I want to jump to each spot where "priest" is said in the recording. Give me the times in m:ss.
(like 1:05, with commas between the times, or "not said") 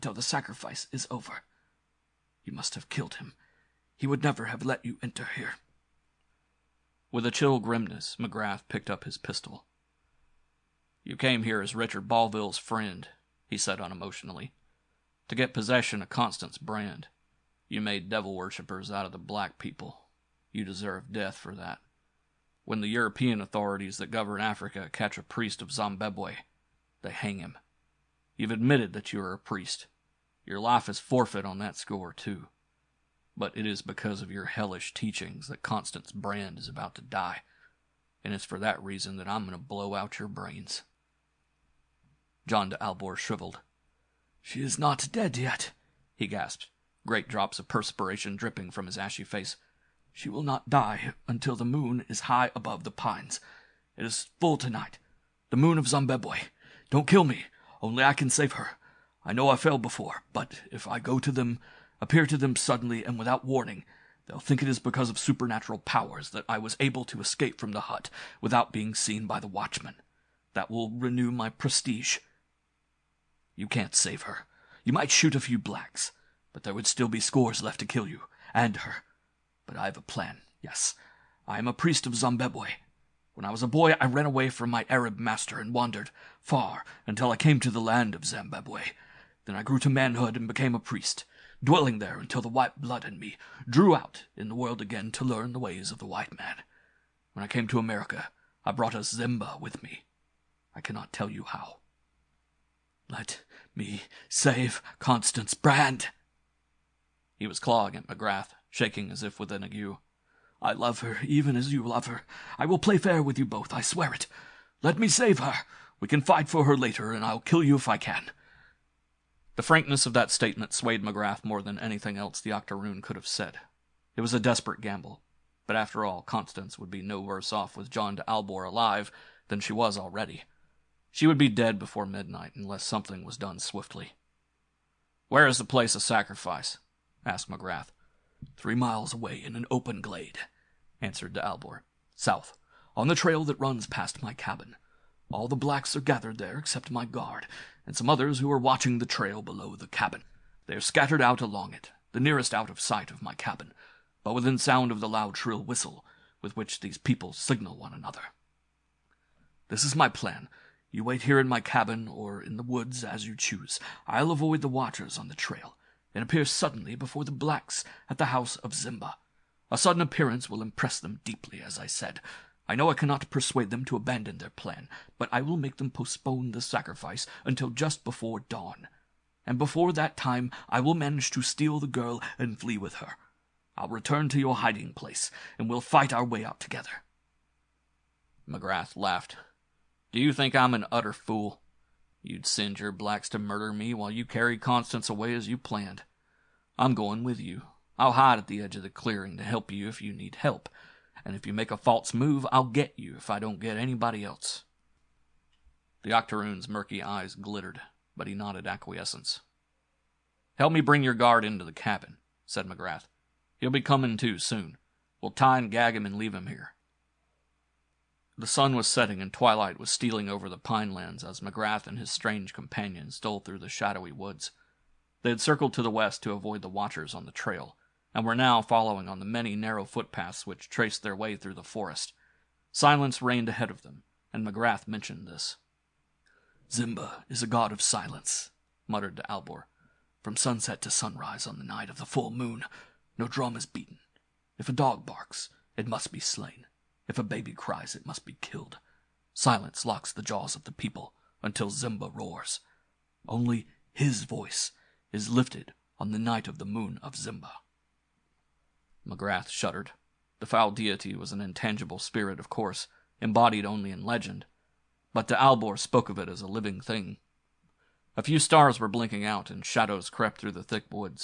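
0:25, 0:29, 1:21, 1:30.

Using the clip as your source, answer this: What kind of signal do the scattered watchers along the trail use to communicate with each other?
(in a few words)
loud shrill whistle.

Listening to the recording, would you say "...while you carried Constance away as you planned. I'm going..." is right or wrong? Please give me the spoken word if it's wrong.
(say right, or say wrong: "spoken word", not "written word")
right.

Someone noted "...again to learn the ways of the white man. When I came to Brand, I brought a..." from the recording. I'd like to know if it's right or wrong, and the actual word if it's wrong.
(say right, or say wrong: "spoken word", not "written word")
wrong: "America", not "Brand".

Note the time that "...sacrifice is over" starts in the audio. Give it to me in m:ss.
0:00.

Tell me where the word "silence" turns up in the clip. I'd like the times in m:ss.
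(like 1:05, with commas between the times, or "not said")
3:52, 3:57, 4:09.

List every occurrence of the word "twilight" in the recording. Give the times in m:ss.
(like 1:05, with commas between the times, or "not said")
3:39.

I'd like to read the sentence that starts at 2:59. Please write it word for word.
And before that time I will manage to steal the girl and flee with her.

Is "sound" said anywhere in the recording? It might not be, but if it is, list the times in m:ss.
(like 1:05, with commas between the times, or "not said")
2:34.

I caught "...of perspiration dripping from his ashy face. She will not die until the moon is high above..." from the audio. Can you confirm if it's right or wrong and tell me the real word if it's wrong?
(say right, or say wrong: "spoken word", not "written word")
right.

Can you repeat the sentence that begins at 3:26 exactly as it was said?
The Octoroon's murky eyes glittered, but he nodded acquiescence.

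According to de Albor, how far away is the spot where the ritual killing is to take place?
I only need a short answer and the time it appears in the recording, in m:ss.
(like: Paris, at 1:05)
3 miles, at 2:18.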